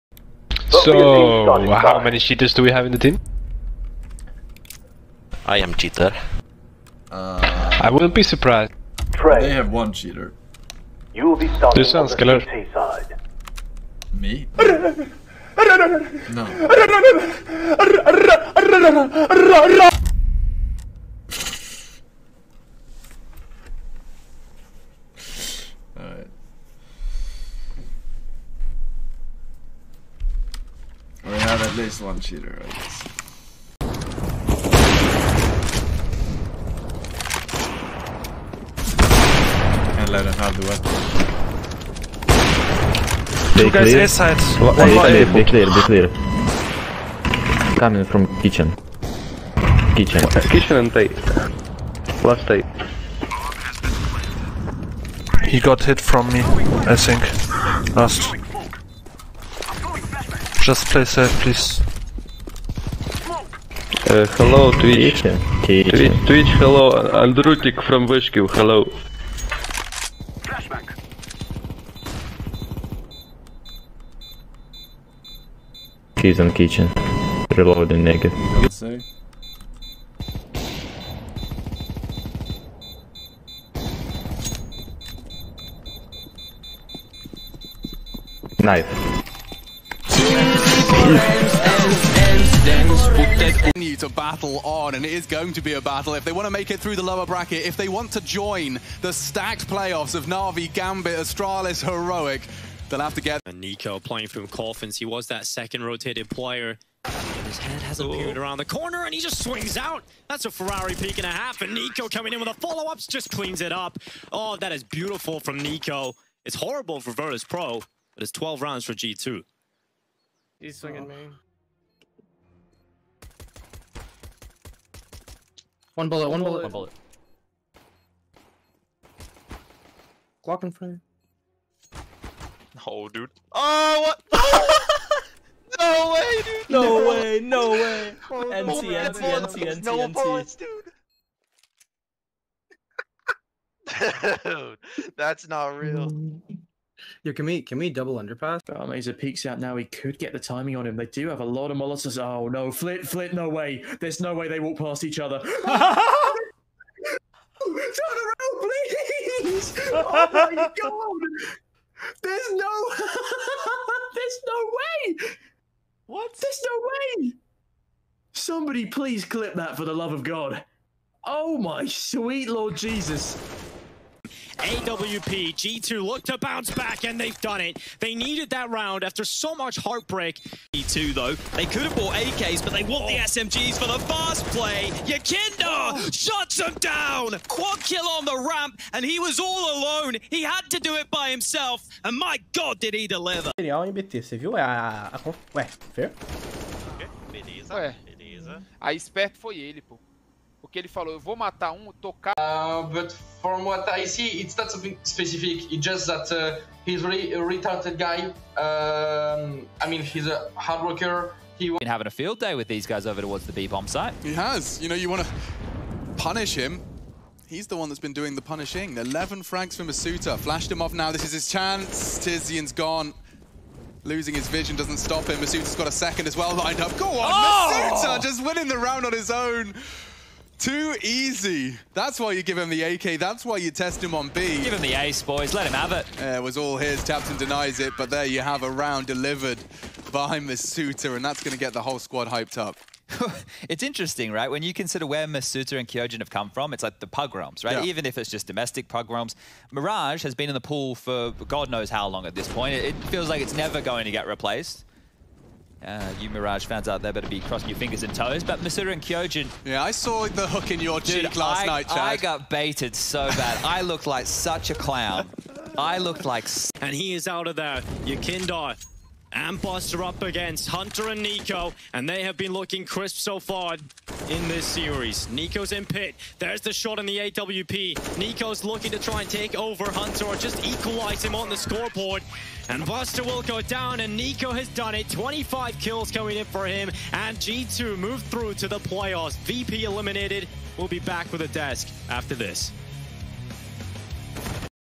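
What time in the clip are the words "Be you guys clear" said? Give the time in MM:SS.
00:43.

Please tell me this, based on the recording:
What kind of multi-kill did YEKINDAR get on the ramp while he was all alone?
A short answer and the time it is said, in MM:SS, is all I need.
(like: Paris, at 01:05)
Quad kill, at 03:07.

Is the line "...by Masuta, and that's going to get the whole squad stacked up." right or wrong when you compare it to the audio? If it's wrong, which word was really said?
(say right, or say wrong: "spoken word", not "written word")
wrong: "hyped", not "stacked".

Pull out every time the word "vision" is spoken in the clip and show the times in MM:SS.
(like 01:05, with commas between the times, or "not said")
03:44.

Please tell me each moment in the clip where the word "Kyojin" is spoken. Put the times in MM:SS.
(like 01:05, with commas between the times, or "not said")
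04:05, 04:19.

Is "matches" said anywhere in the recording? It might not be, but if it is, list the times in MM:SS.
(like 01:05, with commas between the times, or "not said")
not said.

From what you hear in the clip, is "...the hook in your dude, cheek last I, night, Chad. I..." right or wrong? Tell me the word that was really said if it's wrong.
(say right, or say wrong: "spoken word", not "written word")
right.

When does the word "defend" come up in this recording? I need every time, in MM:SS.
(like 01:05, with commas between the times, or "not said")
not said.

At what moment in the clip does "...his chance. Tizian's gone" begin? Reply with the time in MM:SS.
03:41.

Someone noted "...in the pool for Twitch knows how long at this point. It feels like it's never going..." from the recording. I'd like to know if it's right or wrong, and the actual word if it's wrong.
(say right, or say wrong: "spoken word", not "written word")
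wrong: "God", not "Twitch".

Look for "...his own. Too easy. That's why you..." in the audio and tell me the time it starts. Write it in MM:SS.
03:49.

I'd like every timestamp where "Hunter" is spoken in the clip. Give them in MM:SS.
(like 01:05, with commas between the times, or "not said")
04:30, 04:39.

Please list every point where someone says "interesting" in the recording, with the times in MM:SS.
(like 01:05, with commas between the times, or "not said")
04:03.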